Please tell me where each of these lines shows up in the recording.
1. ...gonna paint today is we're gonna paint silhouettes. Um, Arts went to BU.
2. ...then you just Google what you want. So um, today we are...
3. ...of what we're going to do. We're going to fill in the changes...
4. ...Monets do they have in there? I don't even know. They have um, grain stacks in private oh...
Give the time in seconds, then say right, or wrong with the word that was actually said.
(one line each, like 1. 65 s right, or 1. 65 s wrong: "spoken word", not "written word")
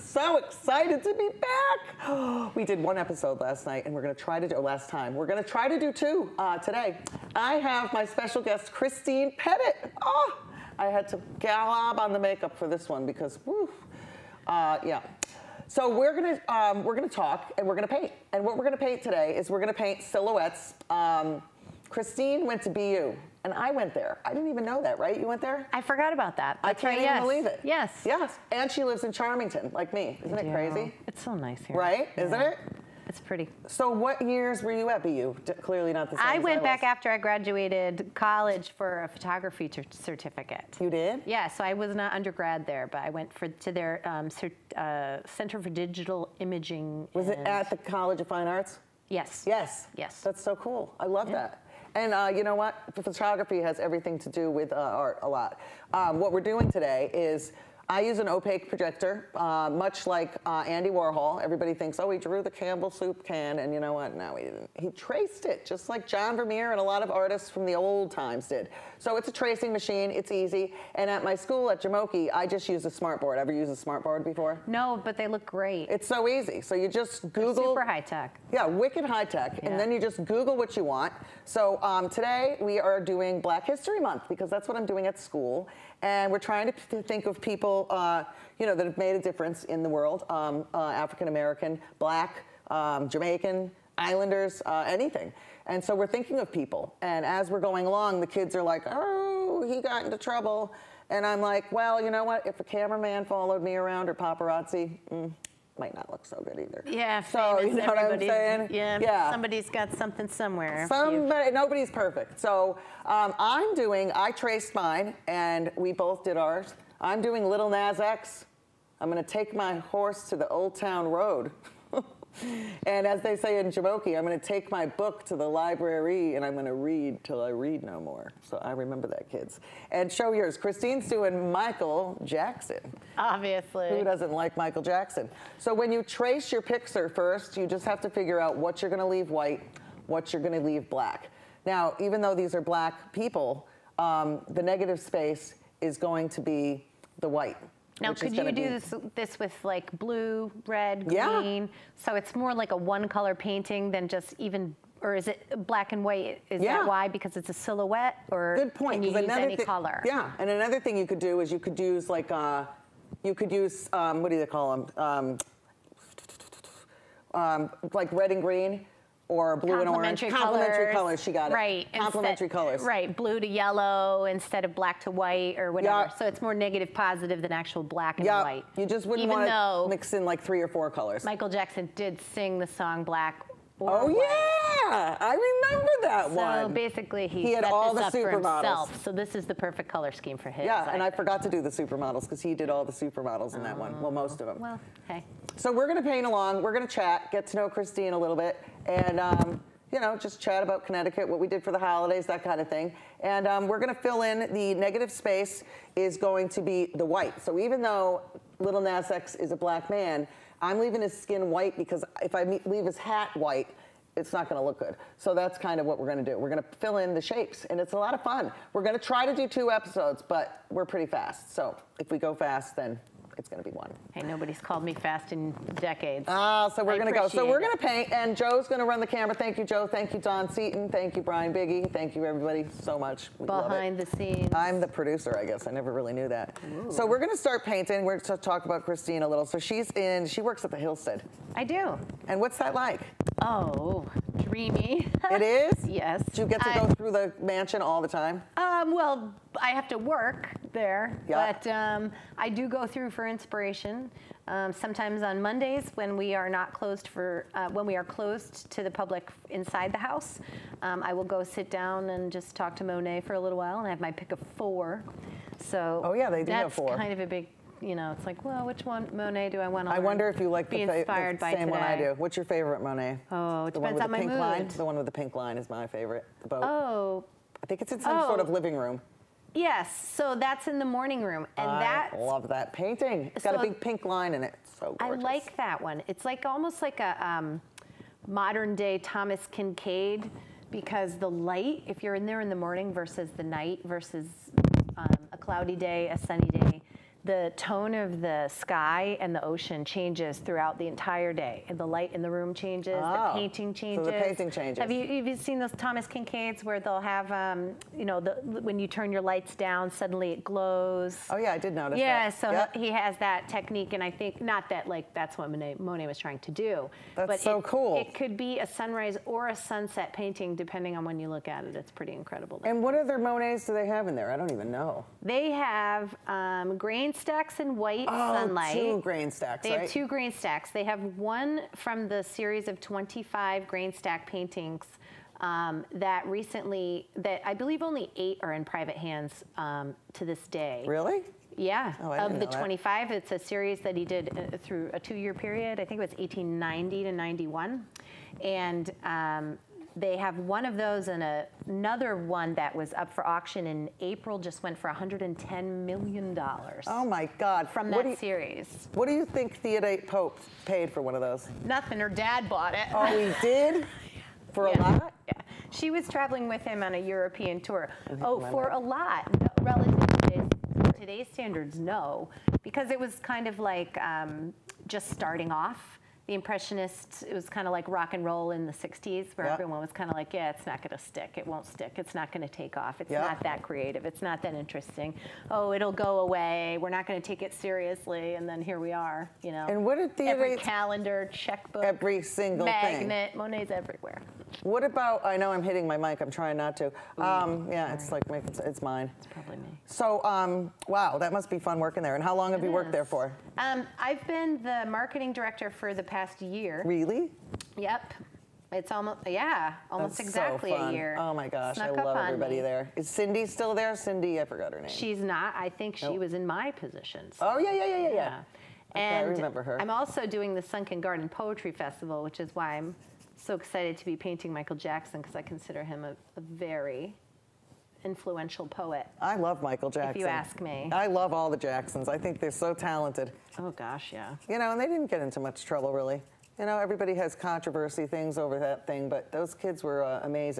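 1. 18 s wrong: "Christine", not "Arts"
2. 79 s right
3. 215 s wrong: "shapes", not "changes"
4. 323 s wrong: "white", not "private".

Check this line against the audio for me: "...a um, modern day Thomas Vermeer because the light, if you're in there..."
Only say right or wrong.
wrong.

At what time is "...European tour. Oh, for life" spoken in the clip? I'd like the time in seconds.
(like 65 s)
366 s.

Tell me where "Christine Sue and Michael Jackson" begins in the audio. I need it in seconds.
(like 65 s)
130 s.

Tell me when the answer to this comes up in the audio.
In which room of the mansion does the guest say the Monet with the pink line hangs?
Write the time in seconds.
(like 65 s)
280 s.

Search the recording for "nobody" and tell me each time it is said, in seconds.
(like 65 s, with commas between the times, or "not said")
111 s, 224 s.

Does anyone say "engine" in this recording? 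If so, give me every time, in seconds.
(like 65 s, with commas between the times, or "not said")
not said.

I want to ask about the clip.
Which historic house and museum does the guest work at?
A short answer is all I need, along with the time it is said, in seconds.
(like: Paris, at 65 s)
Hillstead, at 240 s.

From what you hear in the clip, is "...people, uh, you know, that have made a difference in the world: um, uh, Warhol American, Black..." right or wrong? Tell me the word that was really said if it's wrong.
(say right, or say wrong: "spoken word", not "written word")
wrong: "African", not "Warhol".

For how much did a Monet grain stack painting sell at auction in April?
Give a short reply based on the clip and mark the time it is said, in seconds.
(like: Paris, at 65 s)
$110 million, at 354 s.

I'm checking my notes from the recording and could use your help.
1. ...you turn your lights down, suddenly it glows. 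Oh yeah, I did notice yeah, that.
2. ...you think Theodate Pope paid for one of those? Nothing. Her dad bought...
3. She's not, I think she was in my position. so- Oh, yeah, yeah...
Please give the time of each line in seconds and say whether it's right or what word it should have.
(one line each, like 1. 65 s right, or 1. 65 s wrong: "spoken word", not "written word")
1. 308 s right
2. 359 s right
3. 414 s right.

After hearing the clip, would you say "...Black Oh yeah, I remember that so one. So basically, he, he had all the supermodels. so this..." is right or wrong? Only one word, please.
right.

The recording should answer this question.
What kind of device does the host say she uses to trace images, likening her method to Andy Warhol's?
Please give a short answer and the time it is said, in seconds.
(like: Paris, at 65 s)
Opaque projector, at 58 s.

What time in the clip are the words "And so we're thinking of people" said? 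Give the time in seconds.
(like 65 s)
95 s.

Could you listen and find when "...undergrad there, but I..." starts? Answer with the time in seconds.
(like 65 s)
42 s.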